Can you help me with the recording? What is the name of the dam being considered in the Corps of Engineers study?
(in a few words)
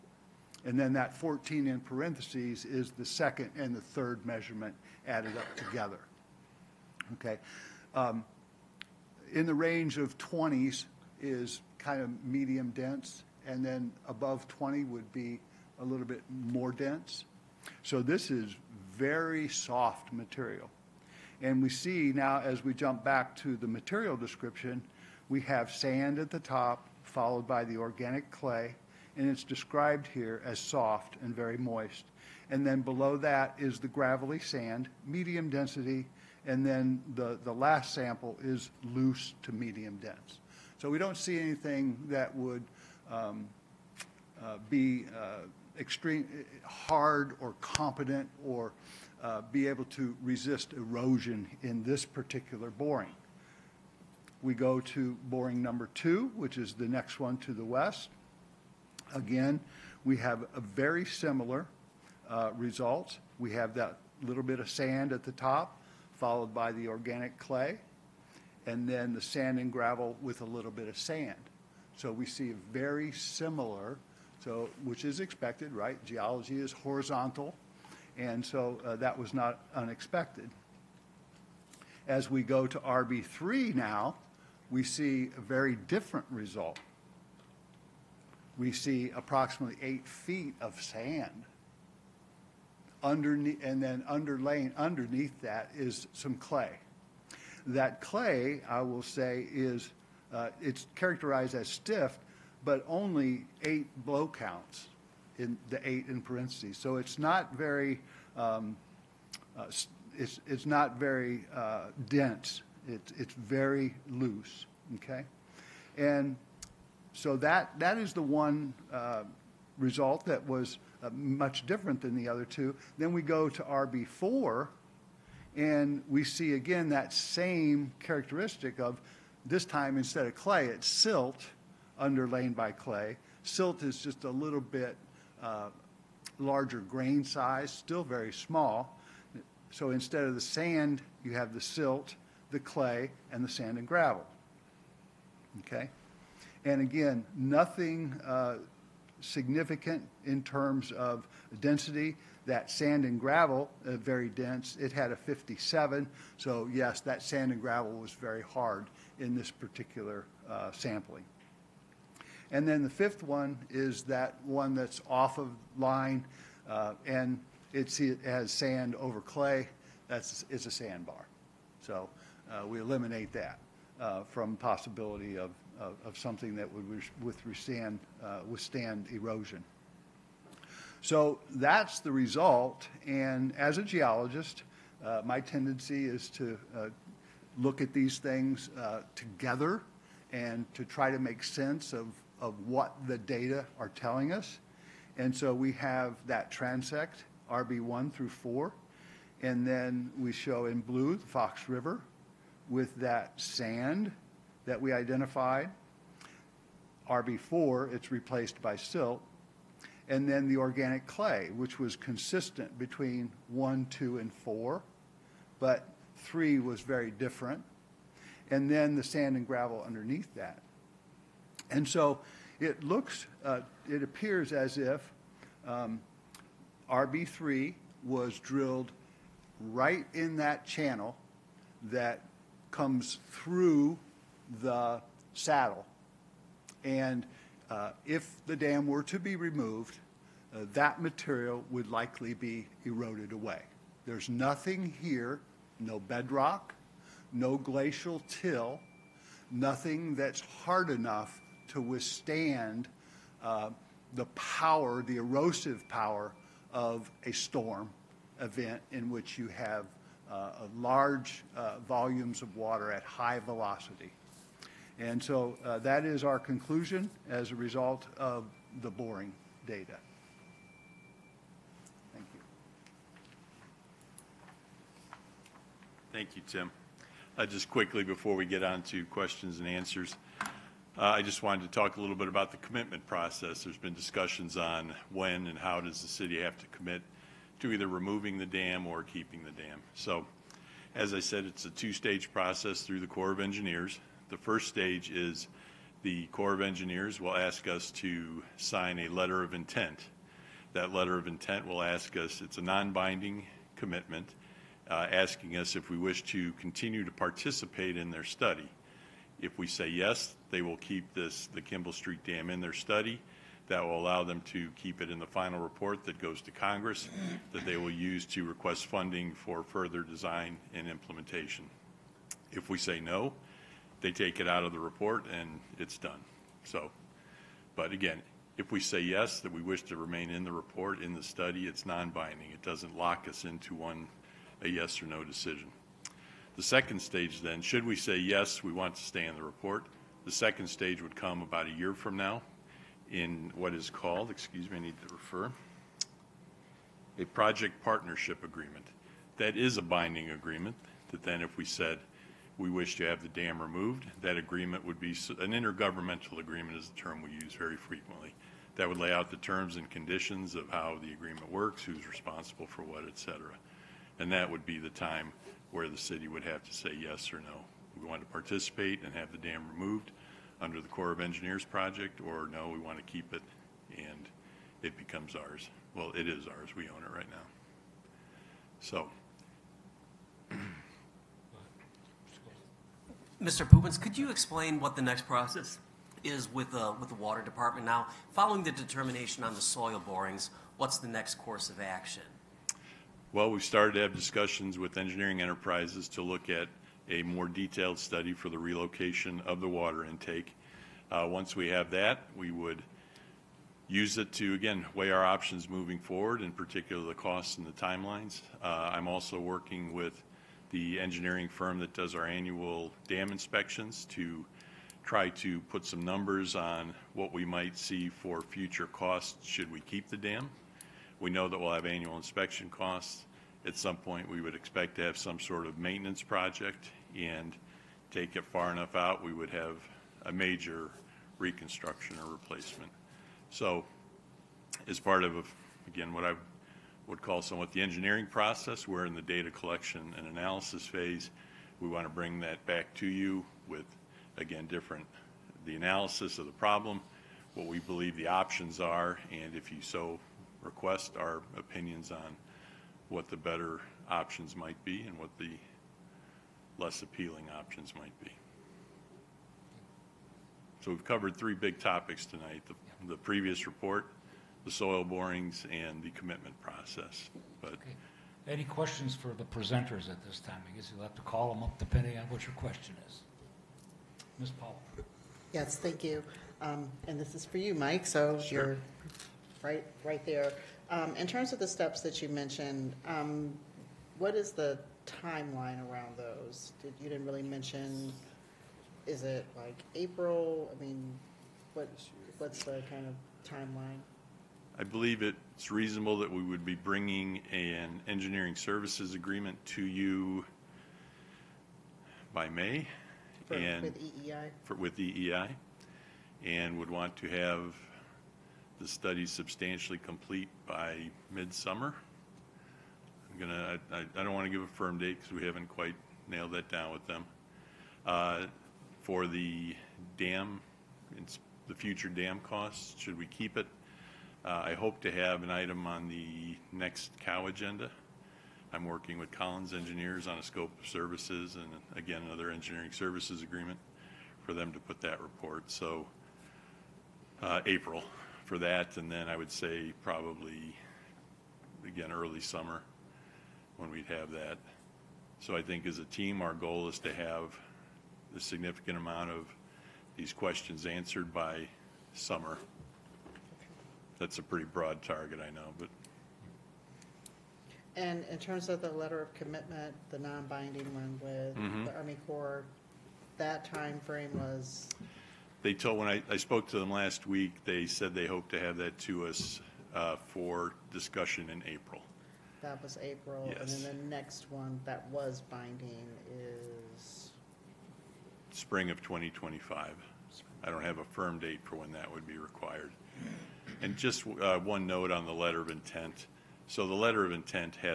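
Kimball Street Dam.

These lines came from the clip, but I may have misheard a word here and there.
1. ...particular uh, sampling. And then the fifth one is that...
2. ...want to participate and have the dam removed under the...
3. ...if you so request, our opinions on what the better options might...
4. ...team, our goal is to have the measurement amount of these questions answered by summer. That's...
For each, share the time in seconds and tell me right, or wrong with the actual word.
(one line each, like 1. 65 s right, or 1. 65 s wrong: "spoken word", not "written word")
1. 159 s right
2. 368 s right
3. 449 s right
4. 546 s wrong: "significant", not "measurement".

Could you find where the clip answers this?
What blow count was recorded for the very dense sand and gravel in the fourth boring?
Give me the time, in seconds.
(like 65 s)
155 s.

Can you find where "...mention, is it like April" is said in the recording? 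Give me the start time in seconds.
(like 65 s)
487 s.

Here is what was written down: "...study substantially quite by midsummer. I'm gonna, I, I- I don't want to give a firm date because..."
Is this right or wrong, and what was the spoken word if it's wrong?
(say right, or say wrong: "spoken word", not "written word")
wrong: "complete", not "quite".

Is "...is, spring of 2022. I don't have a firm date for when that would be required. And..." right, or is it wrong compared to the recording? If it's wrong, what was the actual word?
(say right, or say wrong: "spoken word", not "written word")
wrong: "2025", not "2022".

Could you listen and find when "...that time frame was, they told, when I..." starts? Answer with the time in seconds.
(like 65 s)
563 s.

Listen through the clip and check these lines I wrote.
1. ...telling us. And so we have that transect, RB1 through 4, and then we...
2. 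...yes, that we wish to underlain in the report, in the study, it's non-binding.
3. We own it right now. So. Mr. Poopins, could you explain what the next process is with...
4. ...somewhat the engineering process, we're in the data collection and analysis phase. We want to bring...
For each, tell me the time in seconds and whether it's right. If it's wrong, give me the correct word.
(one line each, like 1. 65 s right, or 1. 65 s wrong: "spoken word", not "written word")
1. 193 s right
2. 328 s wrong: "remain", not "underlain"
3. 376 s right
4. 437 s right.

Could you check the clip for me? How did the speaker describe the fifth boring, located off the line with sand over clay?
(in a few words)
a sandbar.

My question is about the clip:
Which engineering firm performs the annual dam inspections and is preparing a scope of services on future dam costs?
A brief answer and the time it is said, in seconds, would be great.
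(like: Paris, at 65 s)
Collins Engineers, at 529 s.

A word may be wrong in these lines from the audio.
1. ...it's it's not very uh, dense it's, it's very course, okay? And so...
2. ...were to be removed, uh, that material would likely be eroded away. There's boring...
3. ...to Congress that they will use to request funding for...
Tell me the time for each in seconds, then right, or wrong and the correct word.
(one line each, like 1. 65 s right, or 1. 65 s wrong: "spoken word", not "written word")
1. 110 s wrong: "loose", not "course"
2. 238 s wrong: "nothing", not "boring"
3. 316 s right.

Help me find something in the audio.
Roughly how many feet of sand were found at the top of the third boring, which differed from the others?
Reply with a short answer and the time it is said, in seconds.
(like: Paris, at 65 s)
8, at 89 s.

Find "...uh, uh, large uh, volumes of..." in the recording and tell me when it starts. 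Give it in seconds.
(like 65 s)
260 s.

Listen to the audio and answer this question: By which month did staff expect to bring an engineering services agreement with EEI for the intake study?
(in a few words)
May.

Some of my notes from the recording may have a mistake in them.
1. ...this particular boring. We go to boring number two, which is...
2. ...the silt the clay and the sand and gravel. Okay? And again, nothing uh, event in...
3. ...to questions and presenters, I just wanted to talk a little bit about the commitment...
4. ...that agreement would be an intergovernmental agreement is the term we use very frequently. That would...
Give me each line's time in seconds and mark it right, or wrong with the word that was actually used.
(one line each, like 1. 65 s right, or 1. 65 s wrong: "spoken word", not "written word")
1. 51 s right
2. 141 s wrong: "significant", not "event"
3. 278 s wrong: "answers", not "presenters"
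4. 354 s right.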